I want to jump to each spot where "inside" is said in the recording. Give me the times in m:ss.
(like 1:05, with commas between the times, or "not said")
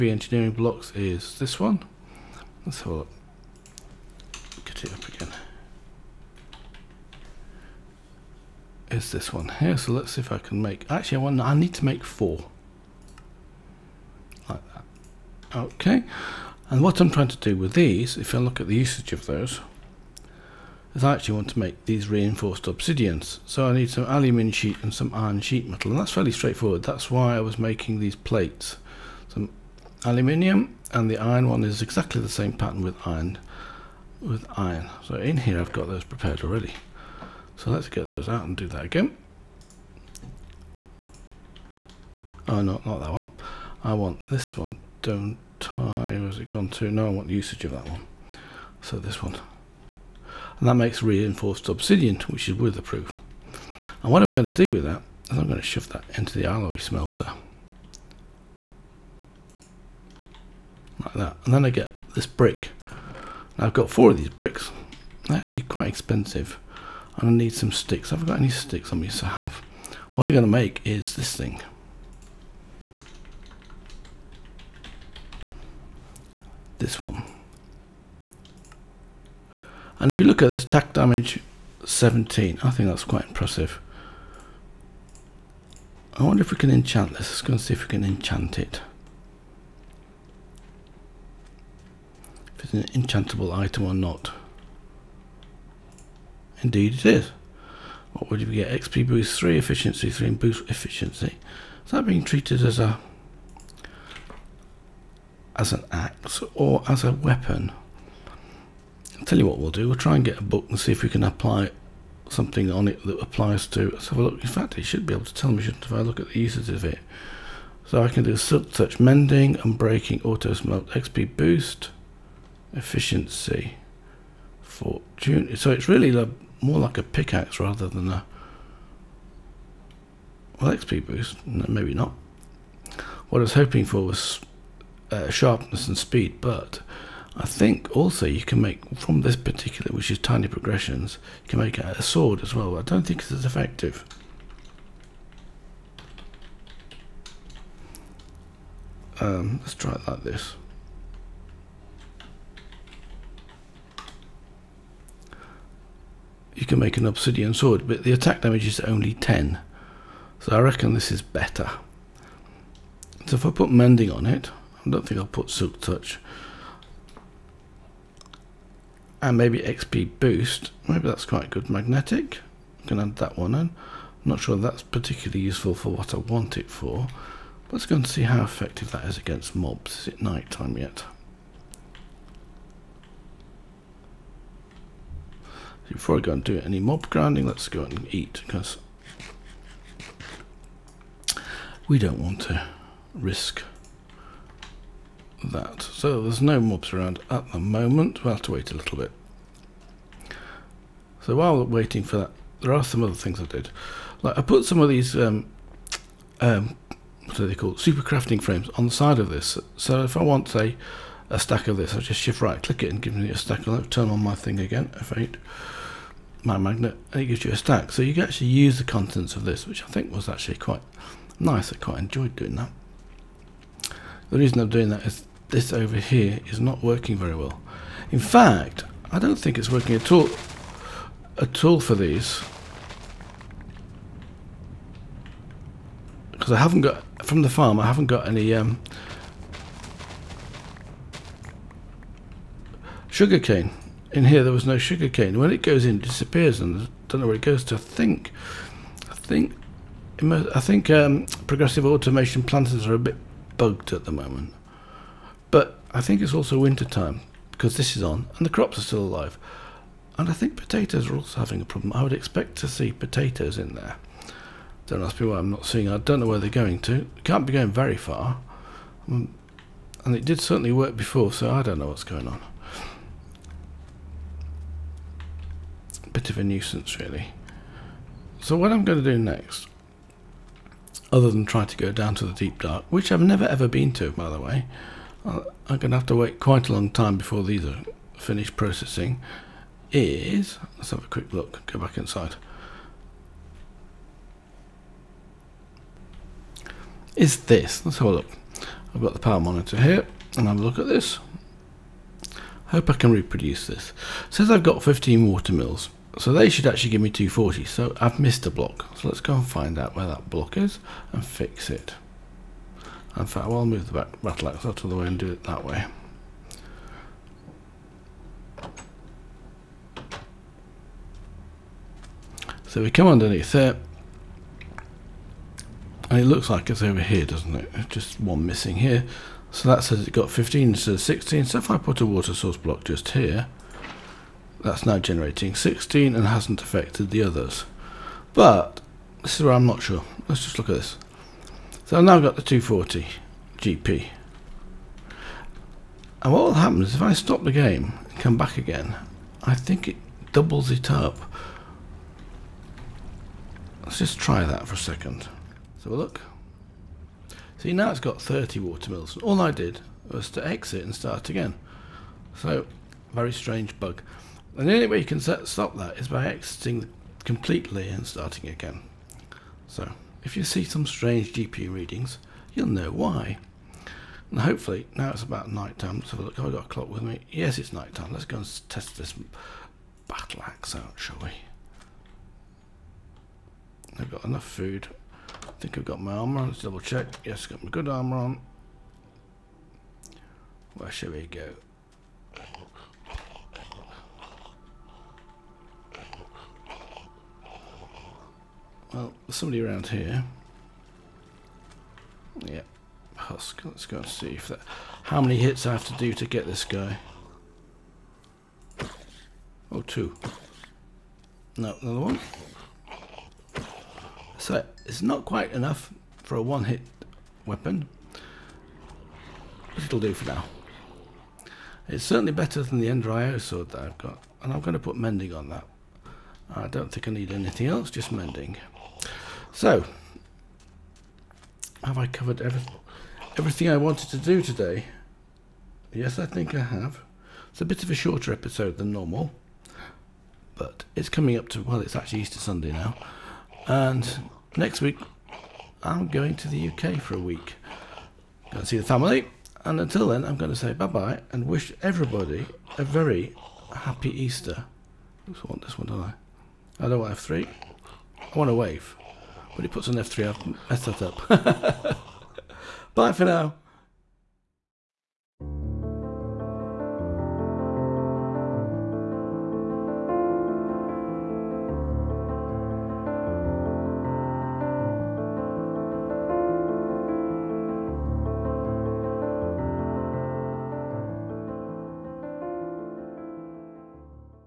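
4:51.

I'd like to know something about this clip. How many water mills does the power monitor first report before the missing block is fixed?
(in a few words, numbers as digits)
15.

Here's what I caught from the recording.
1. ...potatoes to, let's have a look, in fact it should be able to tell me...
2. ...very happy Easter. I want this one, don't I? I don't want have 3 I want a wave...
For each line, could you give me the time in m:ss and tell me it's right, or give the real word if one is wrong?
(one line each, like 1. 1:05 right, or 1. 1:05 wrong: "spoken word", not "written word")
1. 1:53 wrong: "applies", not "potatoes"
2. 7:32 right.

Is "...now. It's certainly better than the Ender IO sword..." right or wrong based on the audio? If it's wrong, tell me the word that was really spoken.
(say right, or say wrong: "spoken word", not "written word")
right.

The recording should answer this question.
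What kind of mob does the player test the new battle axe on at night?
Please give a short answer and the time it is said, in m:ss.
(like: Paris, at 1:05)
Husk, at 6:43.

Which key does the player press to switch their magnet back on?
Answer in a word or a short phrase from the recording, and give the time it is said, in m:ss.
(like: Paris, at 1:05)
F8, at 3:34.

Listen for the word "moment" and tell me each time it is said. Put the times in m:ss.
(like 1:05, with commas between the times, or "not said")
3:17, 4:14.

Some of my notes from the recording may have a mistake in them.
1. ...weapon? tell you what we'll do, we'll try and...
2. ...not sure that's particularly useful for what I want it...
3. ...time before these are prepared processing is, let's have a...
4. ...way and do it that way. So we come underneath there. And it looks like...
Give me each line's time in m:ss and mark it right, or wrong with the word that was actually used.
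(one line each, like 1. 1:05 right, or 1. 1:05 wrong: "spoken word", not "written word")
1. 1:47 right
2. 2:54 right
3. 4:46 wrong: "finished", not "prepared"
4. 5:14 right.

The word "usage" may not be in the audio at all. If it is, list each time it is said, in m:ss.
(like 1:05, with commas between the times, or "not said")
0:18, 0:47.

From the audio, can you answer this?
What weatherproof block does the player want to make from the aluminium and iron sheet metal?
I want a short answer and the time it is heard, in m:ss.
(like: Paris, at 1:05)
Reinforced obsidian, at 0:22.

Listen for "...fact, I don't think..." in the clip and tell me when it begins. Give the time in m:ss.
3:48.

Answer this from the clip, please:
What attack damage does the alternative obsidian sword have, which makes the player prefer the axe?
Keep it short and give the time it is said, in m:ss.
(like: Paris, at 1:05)
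10, at 2:38.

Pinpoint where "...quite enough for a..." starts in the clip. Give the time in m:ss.
6:55.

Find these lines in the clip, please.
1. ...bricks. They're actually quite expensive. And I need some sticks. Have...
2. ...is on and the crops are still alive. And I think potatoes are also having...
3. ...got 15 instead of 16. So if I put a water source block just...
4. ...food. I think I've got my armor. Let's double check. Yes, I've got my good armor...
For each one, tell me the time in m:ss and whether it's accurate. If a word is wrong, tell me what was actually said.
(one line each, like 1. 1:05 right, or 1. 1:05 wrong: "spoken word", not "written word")
1. 1:04 right
2. 4:17 right
3. 5:30 right
4. 6:24 right.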